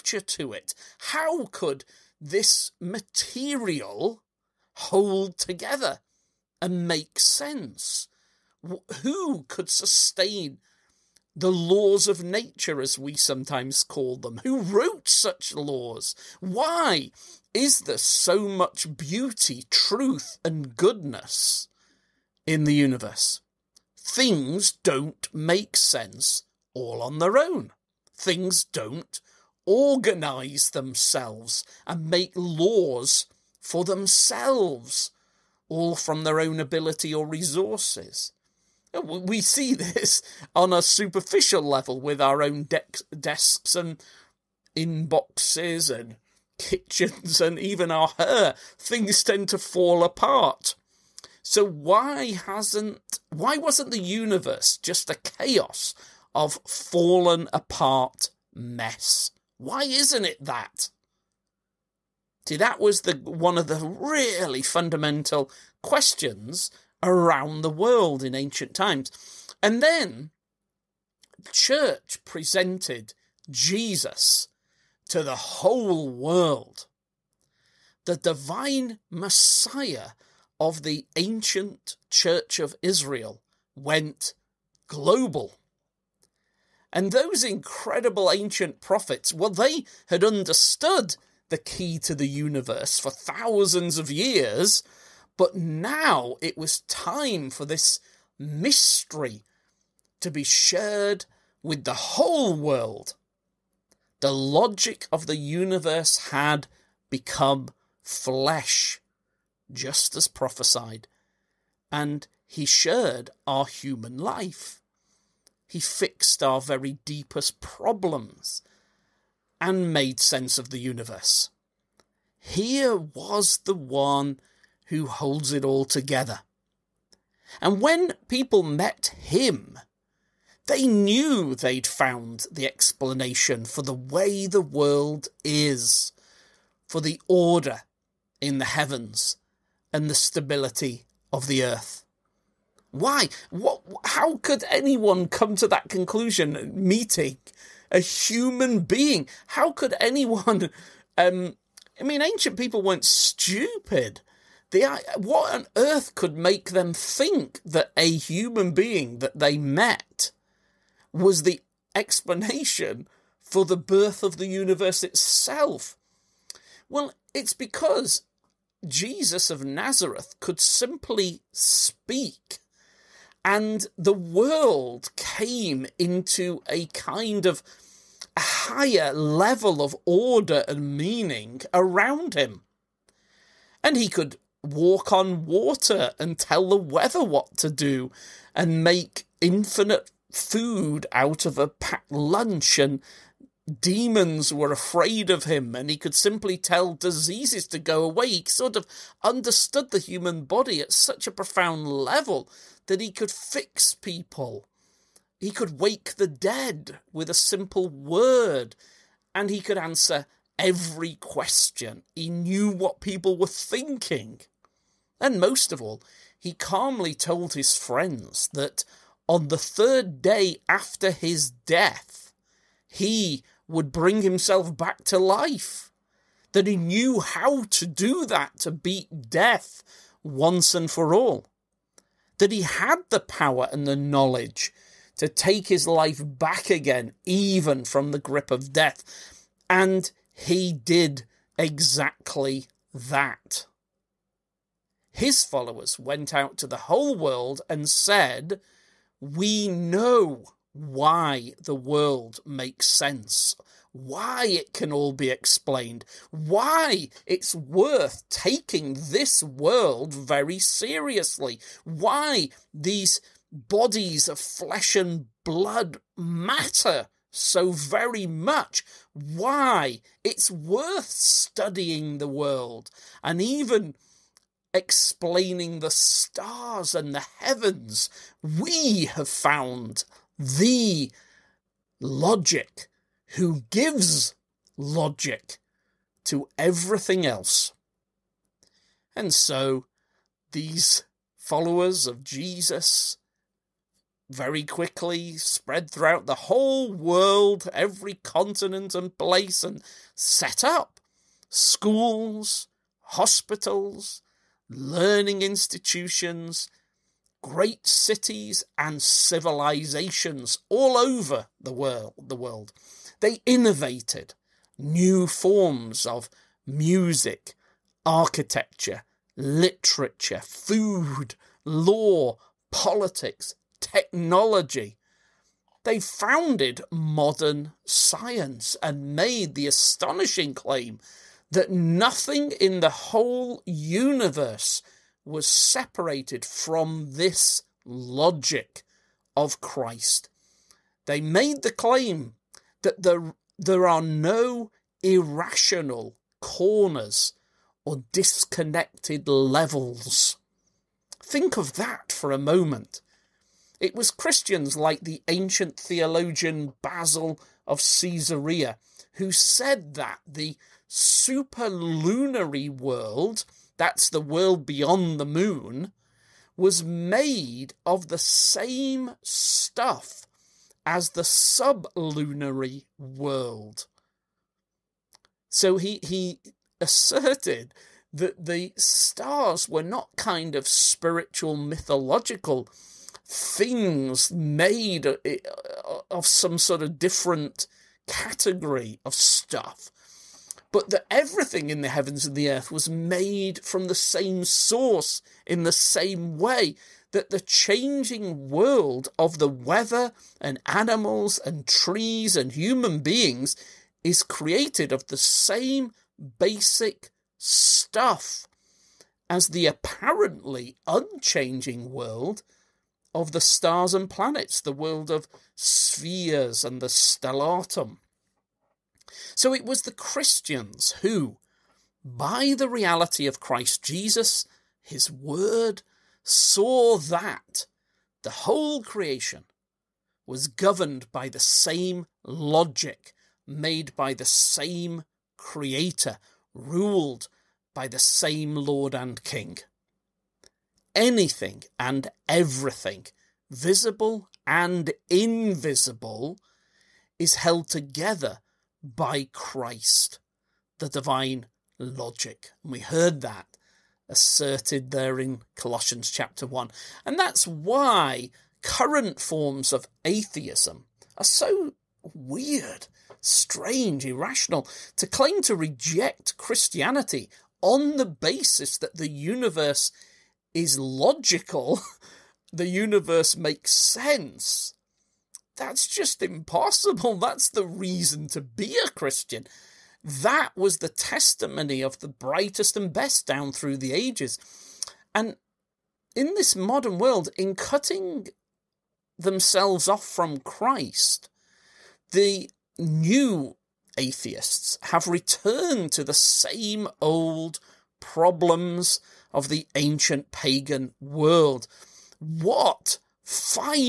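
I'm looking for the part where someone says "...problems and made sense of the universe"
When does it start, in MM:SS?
01:57.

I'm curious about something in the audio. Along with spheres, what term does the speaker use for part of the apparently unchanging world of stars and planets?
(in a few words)
stellatum.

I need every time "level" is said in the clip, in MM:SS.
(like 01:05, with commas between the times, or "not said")
00:41, 02:59, 03:21, 05:49.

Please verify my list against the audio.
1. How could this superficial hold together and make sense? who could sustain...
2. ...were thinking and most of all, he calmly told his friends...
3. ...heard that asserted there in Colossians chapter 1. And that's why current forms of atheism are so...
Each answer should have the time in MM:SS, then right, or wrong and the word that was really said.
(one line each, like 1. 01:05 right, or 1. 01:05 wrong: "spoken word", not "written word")
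1. 00:00 wrong: "material", not "superficial"
2. 03:33 right
3. 07:32 right.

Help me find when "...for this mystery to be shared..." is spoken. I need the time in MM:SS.
01:37.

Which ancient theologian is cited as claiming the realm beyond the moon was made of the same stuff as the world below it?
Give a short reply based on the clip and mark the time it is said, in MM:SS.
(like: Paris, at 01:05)
Basil of Caesarea, at 05:56.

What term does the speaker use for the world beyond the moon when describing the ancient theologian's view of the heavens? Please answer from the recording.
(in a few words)
superlunary world.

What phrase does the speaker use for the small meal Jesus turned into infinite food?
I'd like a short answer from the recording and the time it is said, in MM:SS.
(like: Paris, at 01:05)
a packed lunch, at 03:11.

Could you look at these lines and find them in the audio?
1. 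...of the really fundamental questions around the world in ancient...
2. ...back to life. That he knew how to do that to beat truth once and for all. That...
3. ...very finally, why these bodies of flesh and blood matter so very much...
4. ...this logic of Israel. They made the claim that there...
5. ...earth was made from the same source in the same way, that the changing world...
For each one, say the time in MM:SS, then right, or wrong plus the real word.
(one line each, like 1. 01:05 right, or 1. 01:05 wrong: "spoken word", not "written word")
1. 01:03 right
2. 03:44 wrong: "death", not "truth"
3. 04:20 wrong: "seriously", not "finally"
4. 05:37 wrong: "Christ", not "Israel"
5. 06:32 right.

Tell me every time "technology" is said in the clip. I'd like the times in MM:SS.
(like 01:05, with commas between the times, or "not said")
05:23.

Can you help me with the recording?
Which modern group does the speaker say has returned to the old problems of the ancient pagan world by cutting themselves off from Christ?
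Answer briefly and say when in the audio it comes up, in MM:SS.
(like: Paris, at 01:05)
the new atheists, at 08:12.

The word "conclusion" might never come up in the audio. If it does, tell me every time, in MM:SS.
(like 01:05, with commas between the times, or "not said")
02:25.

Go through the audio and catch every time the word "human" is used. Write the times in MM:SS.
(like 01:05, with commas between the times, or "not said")
01:53, 02:27, 02:38, 03:19, 06:42.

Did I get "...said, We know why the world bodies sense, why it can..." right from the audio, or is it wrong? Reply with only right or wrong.
wrong.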